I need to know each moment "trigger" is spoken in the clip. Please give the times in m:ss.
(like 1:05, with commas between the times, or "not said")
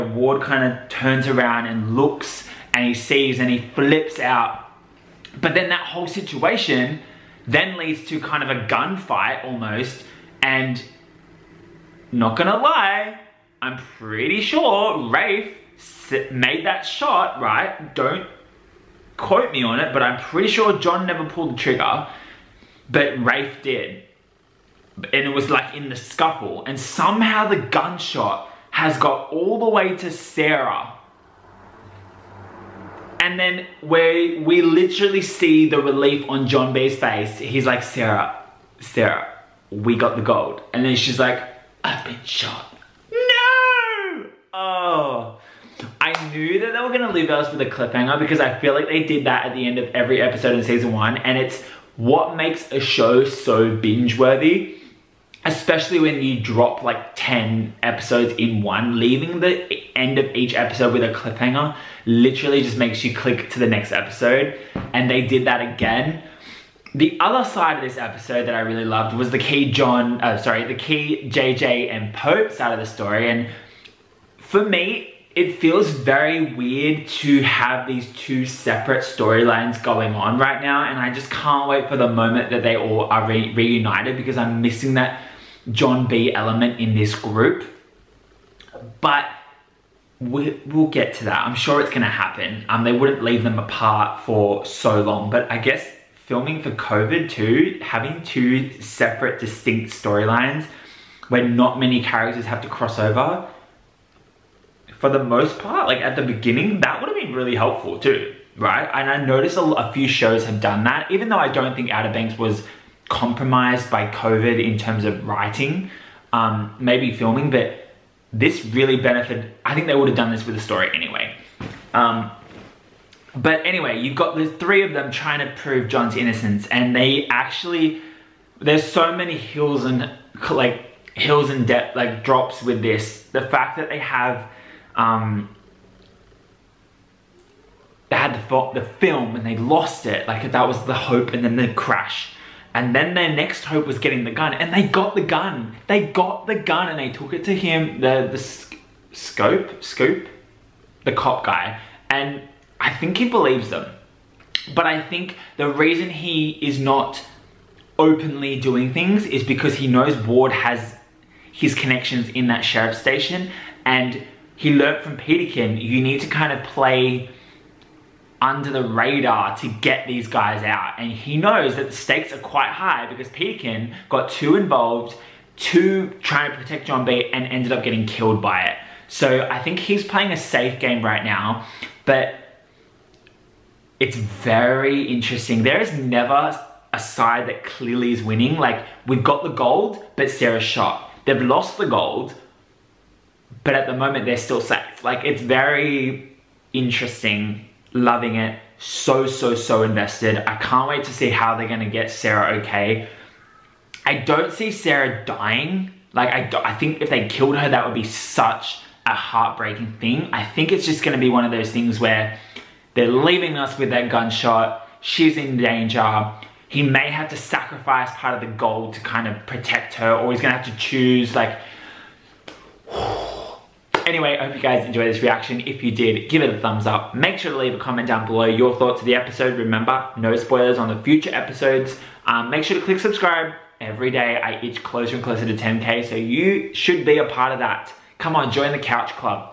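0:21.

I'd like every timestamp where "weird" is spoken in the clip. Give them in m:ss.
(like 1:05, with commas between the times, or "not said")
1:16.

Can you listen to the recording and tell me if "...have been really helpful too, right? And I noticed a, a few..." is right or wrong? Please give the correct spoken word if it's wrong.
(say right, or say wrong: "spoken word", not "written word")
right.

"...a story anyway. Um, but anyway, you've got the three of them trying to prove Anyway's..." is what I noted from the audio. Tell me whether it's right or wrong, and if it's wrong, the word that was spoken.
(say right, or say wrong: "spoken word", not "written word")
wrong: "John", not "Anyway".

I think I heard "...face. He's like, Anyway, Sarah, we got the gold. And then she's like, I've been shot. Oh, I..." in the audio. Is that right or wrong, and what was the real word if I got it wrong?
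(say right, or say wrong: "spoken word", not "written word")
wrong: "Sarah", not "Anyway".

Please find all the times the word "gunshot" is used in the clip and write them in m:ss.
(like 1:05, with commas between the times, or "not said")
0:27, 3:34.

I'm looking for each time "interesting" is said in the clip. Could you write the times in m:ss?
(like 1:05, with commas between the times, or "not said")
3:05, 3:16.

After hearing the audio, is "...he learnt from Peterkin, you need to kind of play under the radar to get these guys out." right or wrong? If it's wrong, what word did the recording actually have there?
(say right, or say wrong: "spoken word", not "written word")
right.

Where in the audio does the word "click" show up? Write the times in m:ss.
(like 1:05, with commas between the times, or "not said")
1:03, 3:52.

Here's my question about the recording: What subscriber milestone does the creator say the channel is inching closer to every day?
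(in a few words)
10K.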